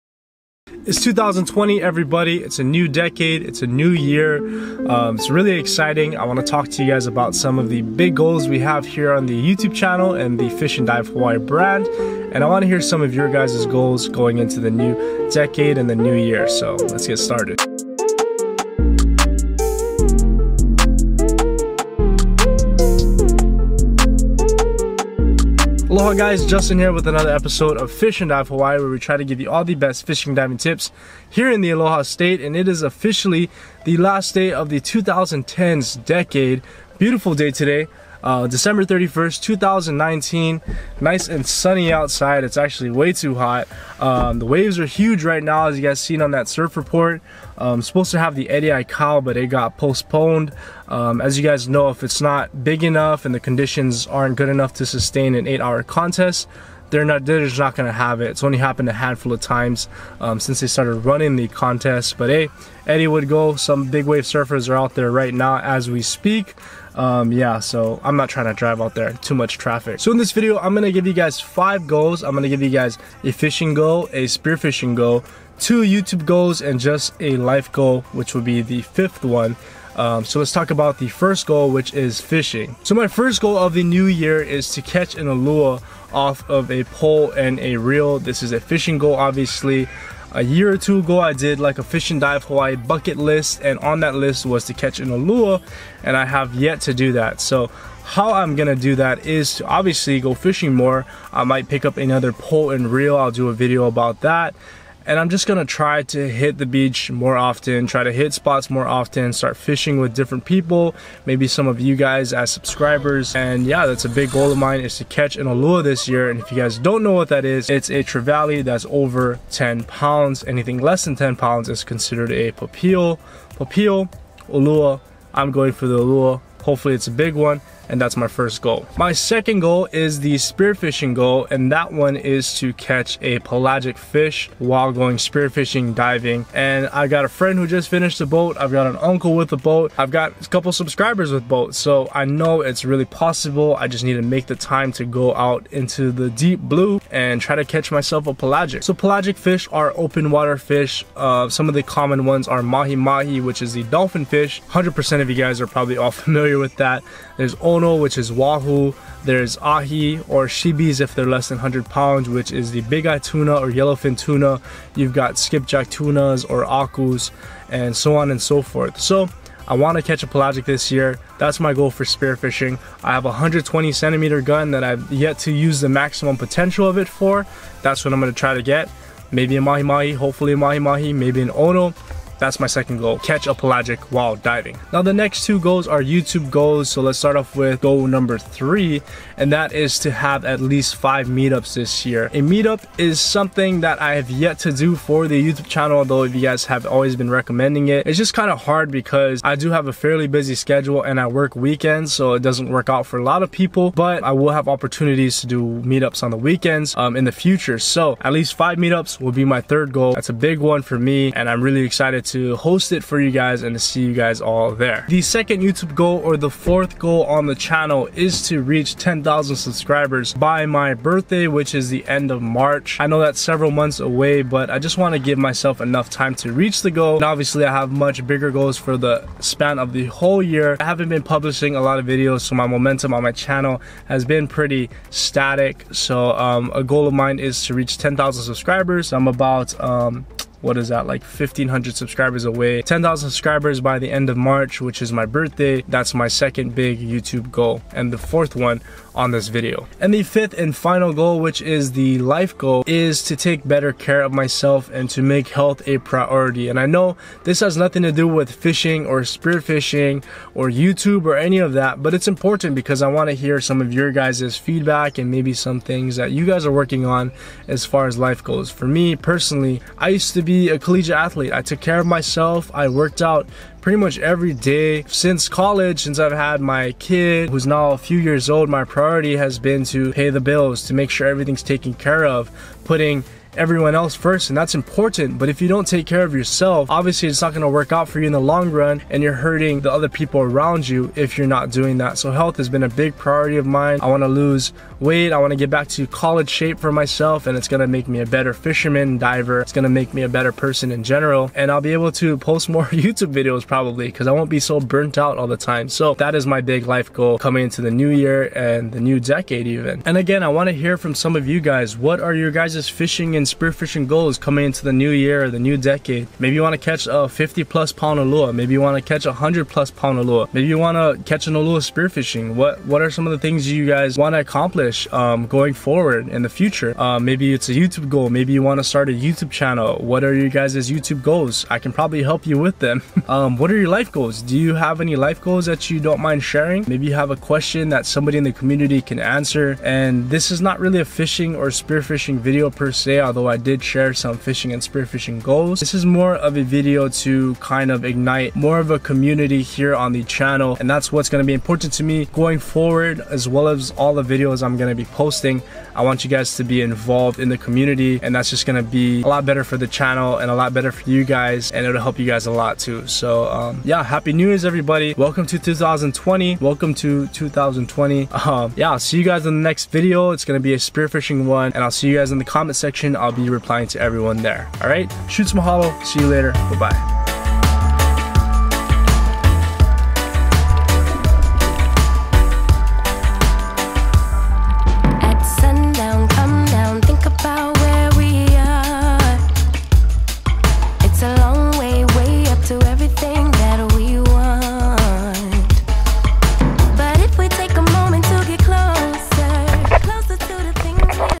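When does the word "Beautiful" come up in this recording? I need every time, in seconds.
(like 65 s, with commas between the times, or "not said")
37 s.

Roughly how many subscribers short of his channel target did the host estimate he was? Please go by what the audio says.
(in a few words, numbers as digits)
1,500.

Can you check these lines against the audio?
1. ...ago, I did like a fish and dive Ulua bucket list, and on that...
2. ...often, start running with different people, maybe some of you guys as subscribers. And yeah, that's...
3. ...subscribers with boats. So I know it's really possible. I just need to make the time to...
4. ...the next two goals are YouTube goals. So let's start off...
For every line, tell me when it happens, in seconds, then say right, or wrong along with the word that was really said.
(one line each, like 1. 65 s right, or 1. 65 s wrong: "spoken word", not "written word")
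1. 90 s wrong: "Hawaii", not "Ulua"
2. 108 s wrong: "fishing", not "running"
3. 140 s right
4. 185 s right.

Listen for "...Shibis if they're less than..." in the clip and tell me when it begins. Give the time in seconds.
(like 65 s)
160 s.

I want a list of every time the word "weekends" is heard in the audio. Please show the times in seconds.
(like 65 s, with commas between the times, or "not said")
201 s, 206 s.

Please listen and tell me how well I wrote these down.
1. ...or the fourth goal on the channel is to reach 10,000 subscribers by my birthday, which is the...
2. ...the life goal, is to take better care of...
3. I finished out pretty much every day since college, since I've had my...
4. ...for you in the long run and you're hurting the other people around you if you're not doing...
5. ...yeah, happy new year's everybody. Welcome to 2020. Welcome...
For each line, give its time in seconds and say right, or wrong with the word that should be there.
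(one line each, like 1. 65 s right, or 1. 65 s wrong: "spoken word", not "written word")
1. 216 s right
2. 251 s right
3. 272 s wrong: "worked", not "finished"
4. 288 s right
5. 363 s right.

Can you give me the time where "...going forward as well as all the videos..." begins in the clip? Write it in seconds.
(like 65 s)
352 s.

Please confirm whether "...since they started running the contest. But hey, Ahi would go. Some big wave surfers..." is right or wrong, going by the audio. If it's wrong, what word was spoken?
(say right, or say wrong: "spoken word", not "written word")
wrong: "Eddie", not "Ahi".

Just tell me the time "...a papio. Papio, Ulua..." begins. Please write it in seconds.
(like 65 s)
122 s.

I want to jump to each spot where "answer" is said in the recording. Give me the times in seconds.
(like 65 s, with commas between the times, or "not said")
339 s.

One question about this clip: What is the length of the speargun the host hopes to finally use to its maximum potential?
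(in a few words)
120 centimeters.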